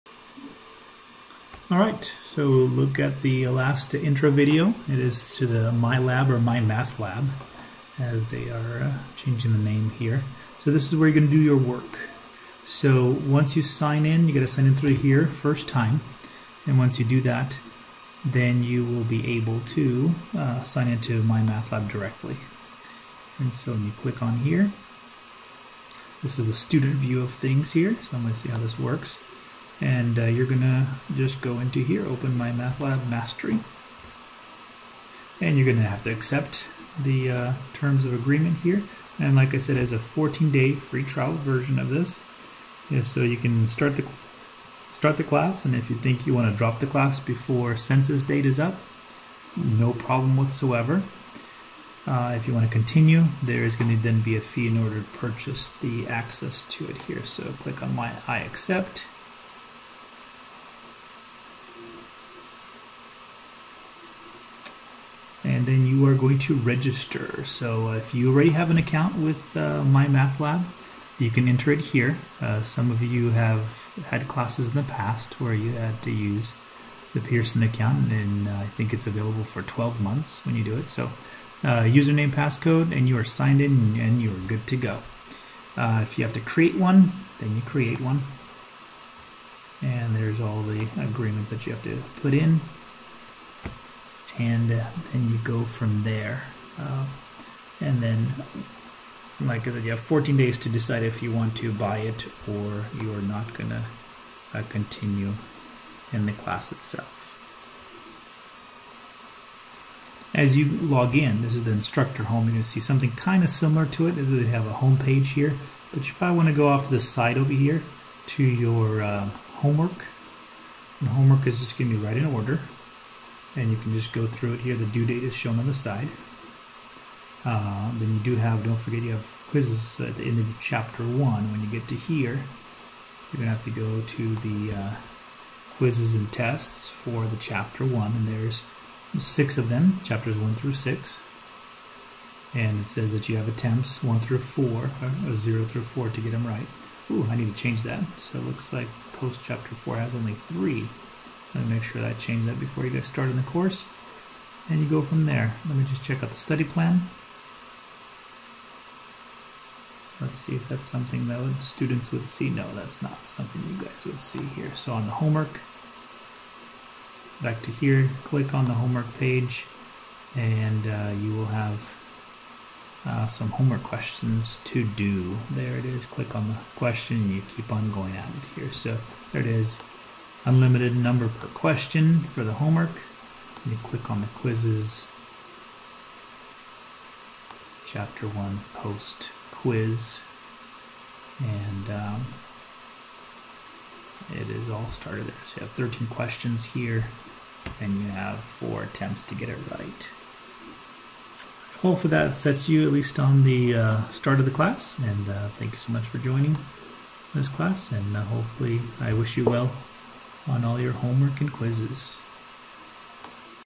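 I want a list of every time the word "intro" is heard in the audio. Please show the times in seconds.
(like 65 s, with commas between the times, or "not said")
4 s.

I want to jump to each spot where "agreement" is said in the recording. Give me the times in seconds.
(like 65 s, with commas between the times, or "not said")
38 s, 90 s.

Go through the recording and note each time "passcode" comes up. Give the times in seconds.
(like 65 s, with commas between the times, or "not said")
82 s.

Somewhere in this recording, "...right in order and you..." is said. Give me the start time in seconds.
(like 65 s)
121 s.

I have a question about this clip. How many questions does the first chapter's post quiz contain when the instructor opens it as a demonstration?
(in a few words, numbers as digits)
13.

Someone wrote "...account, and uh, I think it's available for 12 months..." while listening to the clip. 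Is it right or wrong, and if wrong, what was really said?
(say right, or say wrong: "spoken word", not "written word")
right.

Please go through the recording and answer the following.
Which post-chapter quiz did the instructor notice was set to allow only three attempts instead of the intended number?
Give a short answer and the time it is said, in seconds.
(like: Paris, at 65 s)
post chapter four, at 149 s.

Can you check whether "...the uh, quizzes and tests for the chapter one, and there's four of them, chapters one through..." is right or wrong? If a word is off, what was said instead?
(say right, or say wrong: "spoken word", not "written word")
wrong: "six", not "four".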